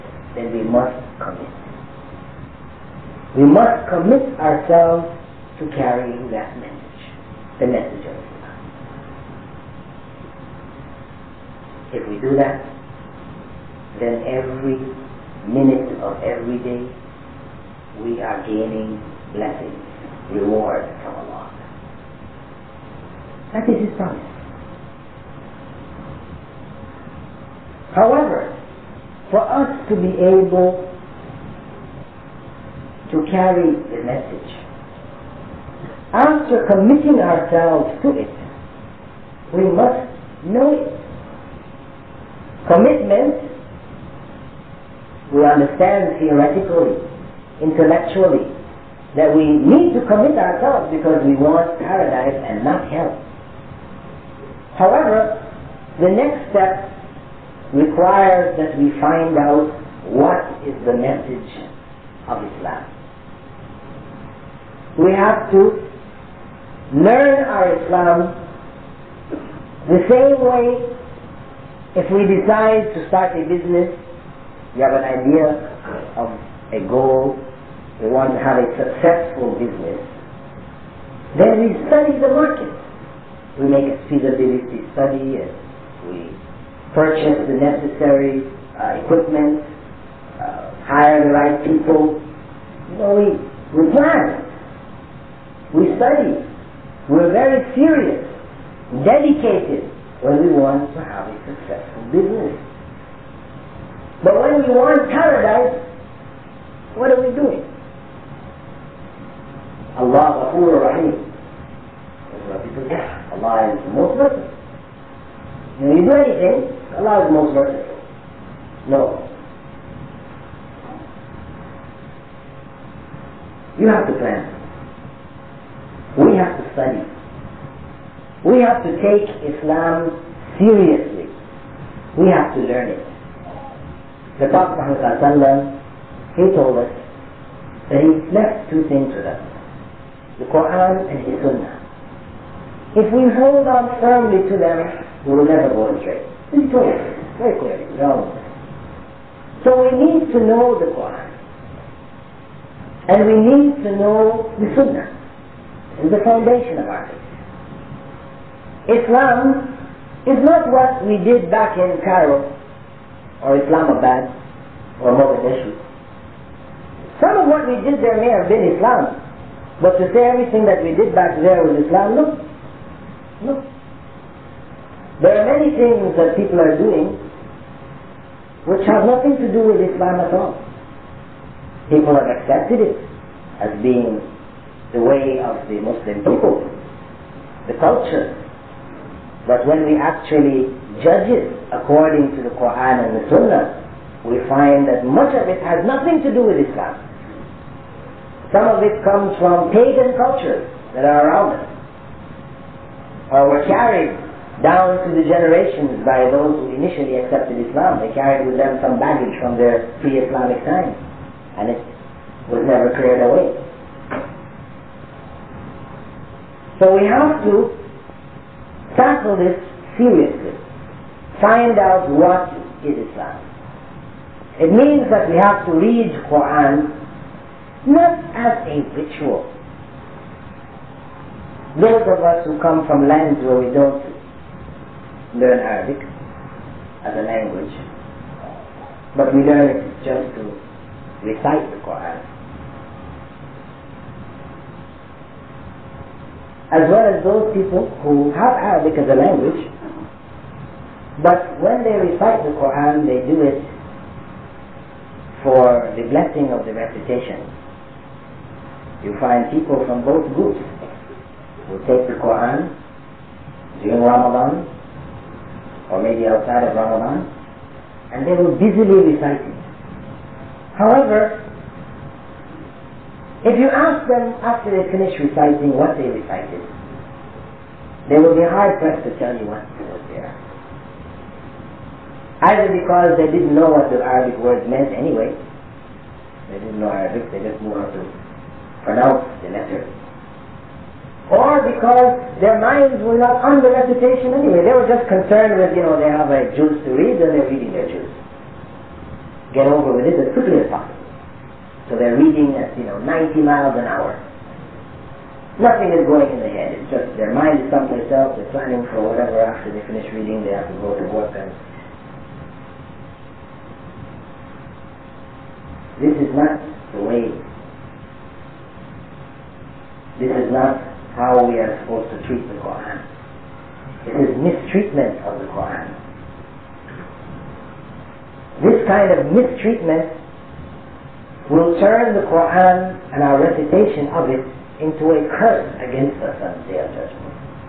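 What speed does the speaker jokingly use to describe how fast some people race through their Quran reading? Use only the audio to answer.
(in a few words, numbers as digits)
90 miles an hour.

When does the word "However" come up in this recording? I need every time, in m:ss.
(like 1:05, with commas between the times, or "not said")
0:27, 0:54, 4:30.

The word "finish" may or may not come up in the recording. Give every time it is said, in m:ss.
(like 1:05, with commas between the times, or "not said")
4:34, 5:09.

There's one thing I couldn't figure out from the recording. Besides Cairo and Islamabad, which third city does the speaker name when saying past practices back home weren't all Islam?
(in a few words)
Mogadishu.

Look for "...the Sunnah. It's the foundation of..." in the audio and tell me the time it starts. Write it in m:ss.
2:34.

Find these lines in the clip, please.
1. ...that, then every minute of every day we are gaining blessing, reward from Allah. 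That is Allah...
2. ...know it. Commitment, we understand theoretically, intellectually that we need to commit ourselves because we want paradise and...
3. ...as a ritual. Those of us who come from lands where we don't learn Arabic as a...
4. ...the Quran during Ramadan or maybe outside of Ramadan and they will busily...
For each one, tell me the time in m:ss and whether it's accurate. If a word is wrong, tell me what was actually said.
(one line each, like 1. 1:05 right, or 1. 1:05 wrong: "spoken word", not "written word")
1. 0:12 wrong: "His", not "Allah"
2. 0:40 right
3. 3:48 right
4. 4:22 right.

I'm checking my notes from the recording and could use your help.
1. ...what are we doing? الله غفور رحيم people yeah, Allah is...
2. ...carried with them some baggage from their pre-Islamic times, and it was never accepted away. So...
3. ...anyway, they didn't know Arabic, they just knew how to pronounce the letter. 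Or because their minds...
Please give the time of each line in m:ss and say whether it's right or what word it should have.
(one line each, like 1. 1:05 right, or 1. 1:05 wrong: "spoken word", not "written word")
1. 1:46 right
2. 3:28 wrong: "cleared", not "accepted"
3. 4:44 right.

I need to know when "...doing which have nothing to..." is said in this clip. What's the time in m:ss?
2:56.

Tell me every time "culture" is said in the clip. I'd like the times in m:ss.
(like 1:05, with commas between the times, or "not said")
3:07, 3:20.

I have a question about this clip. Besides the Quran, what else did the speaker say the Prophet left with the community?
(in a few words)
His Sunnah.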